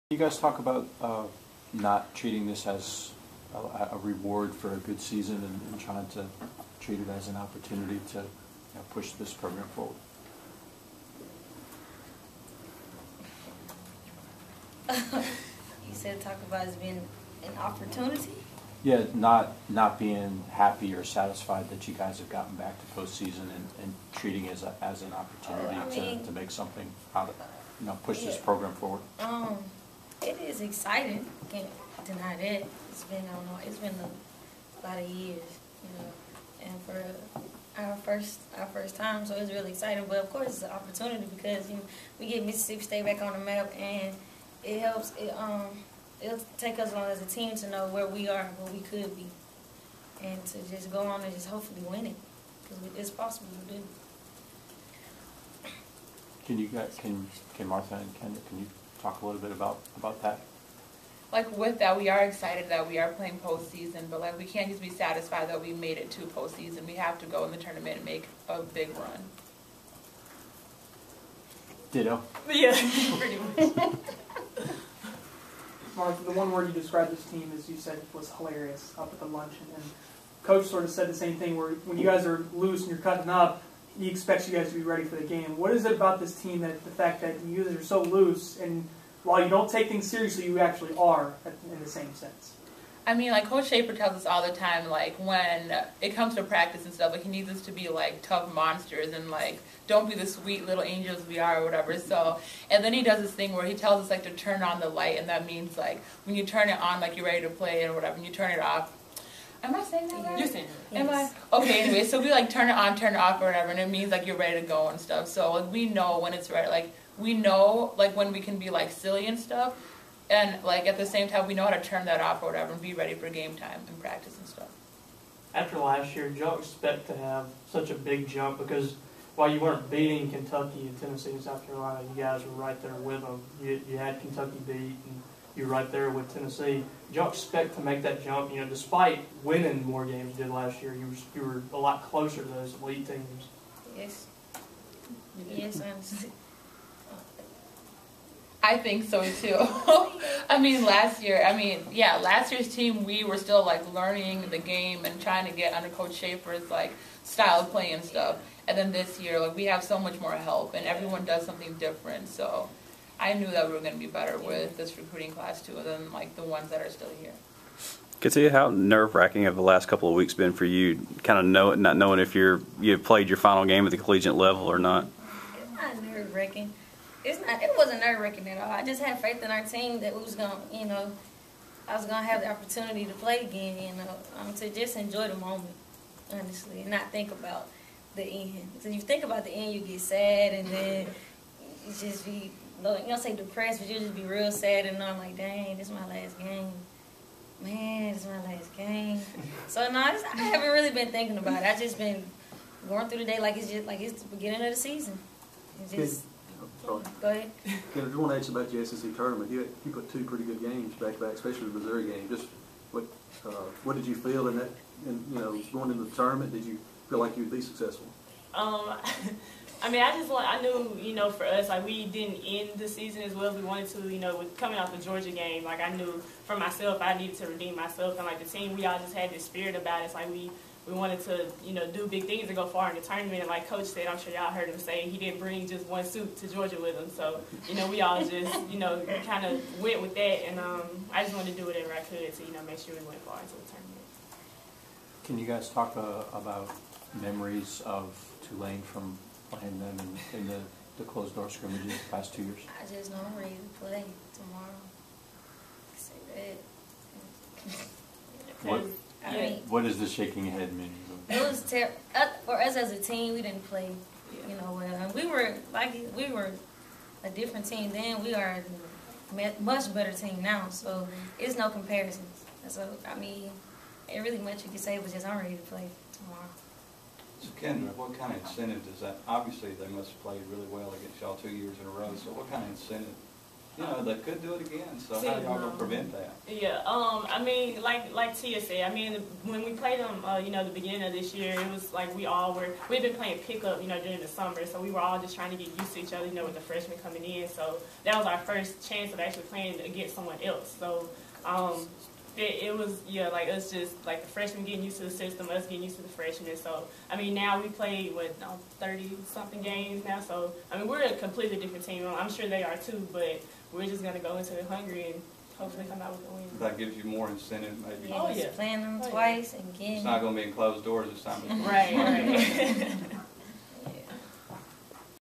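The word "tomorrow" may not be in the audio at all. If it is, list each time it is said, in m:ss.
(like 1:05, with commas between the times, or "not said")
4:14, 4:36.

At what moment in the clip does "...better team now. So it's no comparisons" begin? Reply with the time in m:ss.
4:29.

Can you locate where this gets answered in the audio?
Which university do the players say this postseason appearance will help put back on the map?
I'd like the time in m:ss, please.
0:42.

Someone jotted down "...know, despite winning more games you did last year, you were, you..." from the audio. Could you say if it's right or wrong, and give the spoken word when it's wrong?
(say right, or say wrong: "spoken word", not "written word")
right.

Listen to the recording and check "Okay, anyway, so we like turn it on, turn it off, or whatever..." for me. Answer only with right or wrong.
right.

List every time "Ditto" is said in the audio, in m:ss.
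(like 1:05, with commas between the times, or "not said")
1:11.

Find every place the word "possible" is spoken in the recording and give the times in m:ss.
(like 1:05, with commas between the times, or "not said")
0:53.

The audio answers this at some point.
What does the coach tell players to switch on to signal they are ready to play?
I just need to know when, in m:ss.
1:44.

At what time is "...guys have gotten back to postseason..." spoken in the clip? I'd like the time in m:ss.
0:21.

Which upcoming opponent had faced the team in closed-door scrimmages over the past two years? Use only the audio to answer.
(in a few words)
Tulane.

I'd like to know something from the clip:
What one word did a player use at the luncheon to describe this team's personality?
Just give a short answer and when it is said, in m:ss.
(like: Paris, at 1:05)
hilarious, at 1:18.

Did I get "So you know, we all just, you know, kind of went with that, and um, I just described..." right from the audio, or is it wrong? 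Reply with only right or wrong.
wrong.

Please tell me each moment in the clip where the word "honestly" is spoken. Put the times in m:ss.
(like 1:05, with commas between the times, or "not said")
3:06.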